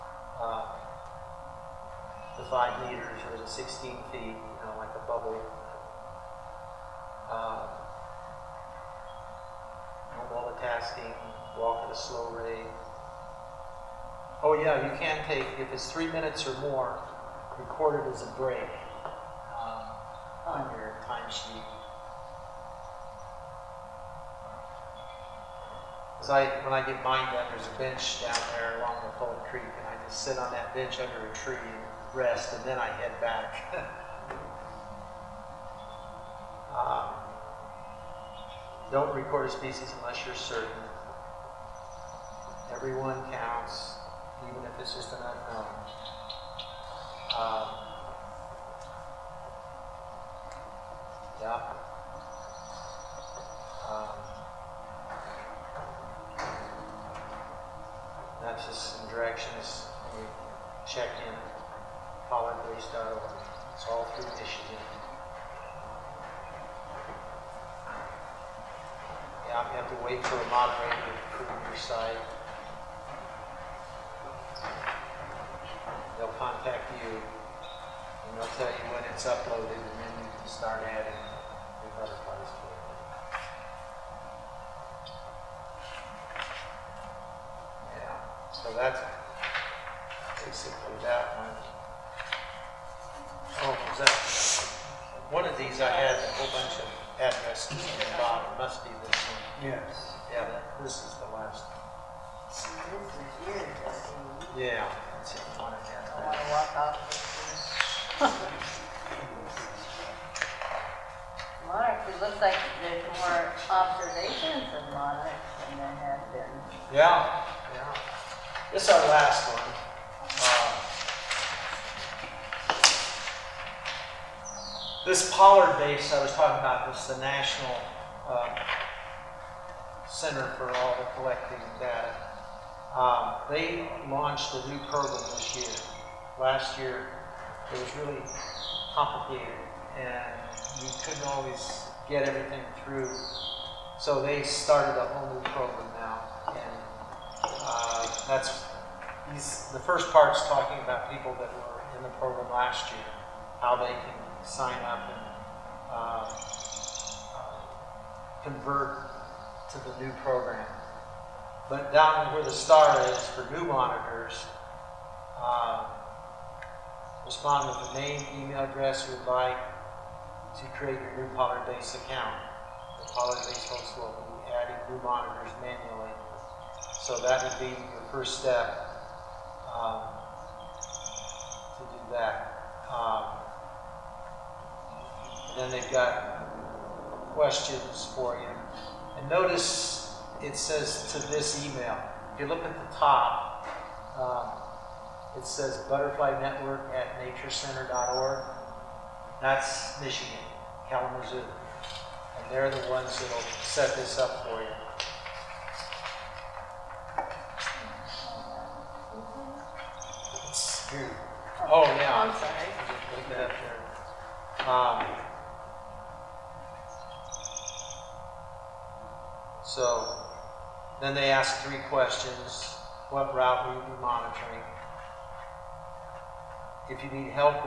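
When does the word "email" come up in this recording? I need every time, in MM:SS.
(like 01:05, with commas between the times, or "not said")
02:48, 03:11.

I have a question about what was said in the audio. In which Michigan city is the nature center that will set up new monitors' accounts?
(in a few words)
Kalamazoo.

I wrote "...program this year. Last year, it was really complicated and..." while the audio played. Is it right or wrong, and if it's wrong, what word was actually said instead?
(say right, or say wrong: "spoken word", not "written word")
right.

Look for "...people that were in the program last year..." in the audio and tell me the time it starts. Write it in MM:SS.
02:31.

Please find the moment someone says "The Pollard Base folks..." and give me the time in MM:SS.
02:53.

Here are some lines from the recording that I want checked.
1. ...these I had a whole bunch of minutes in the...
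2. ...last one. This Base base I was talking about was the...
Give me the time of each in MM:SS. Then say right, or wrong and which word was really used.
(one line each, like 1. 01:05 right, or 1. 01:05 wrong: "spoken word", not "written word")
1. 01:35 wrong: "addresses", not "minutes"
2. 01:59 wrong: "Pollard", not "Base".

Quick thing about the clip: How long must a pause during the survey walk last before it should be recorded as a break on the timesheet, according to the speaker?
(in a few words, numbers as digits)
3 minutes or more.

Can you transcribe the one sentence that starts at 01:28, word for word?
Yeah, so that's basically that one.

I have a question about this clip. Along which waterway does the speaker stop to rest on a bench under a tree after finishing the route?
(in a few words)
Fold Creek.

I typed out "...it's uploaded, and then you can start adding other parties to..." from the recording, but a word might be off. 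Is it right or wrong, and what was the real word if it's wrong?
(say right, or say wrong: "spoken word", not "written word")
right.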